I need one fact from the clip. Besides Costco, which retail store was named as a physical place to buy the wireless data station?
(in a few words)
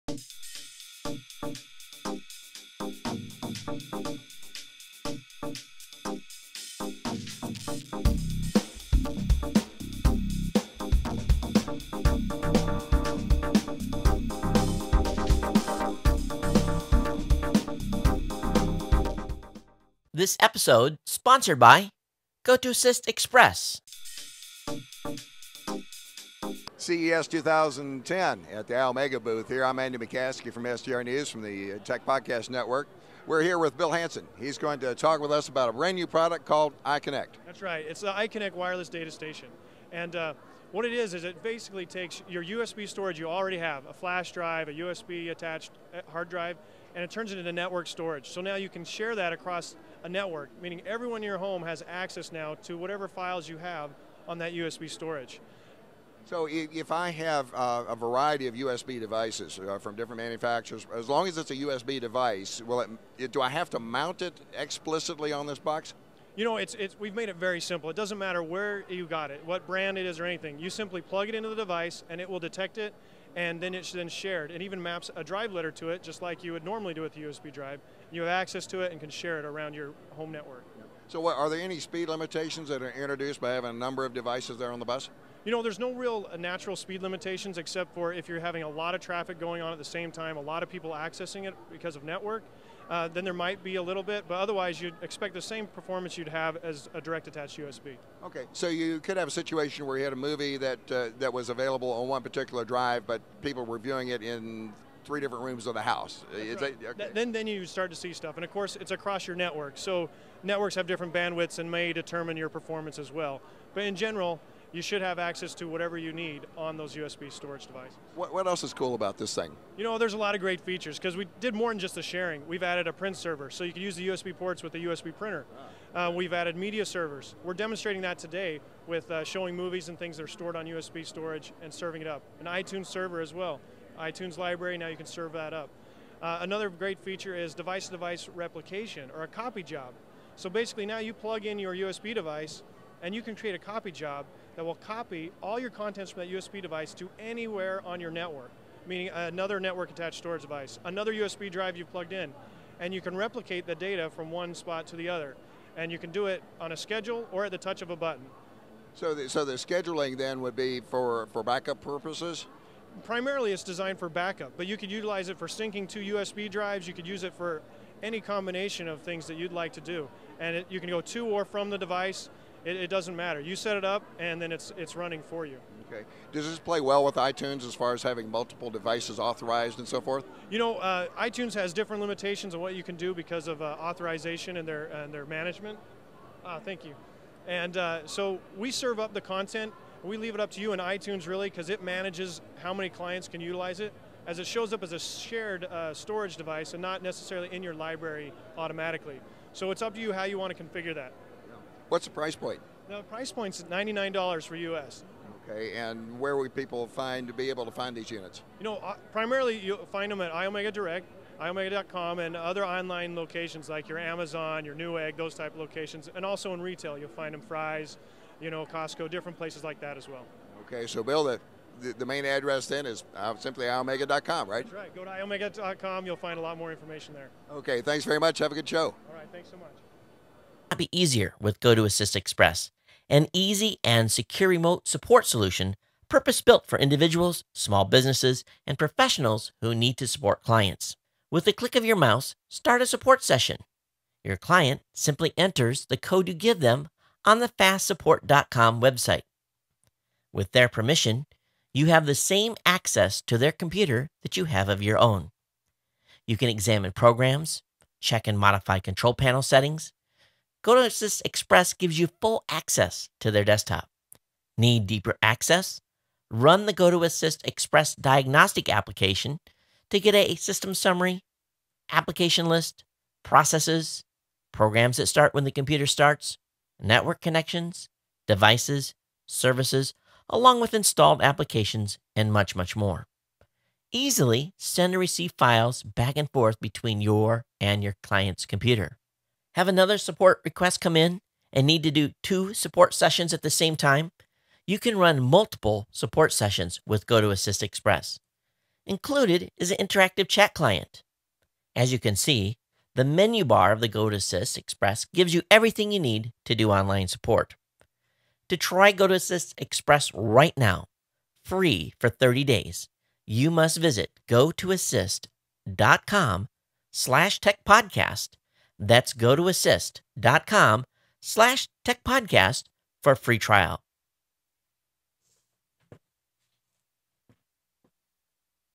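Fry's.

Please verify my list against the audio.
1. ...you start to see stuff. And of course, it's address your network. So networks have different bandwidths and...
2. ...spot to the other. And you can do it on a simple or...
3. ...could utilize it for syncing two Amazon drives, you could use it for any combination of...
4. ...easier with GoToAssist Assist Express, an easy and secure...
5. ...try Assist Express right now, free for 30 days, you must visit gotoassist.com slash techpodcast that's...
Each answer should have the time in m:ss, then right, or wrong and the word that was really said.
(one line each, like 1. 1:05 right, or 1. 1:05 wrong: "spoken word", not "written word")
1. 1:47 wrong: "across", not "address"
2. 2:34 wrong: "schedule", not "simple"
3. 2:44 wrong: "USB", not "Amazon"
4. 3:50 right
5. 5:08 wrong: "GoToAssist", not "Assist".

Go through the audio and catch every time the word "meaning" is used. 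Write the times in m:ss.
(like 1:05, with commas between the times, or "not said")
0:50, 2:28.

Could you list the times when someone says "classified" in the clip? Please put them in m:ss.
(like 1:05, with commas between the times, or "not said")
not said.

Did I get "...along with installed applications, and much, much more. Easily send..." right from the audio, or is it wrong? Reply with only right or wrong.
right.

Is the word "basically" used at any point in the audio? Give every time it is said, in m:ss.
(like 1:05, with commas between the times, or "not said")
0:41, 2:20.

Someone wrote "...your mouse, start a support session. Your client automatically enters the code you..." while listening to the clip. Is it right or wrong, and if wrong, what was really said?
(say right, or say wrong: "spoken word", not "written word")
wrong: "simply", not "automatically".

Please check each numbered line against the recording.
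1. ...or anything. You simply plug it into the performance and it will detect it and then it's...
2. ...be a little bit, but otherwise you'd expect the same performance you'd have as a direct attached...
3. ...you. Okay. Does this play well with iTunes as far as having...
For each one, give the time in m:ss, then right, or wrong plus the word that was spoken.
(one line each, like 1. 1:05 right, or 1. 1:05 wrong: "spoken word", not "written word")
1. 1:10 wrong: "device", not "performance"
2. 1:33 right
3. 2:55 right.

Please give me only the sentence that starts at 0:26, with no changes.
CES 2010 at the Iomega booth here.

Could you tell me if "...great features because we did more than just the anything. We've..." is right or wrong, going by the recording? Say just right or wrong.
wrong.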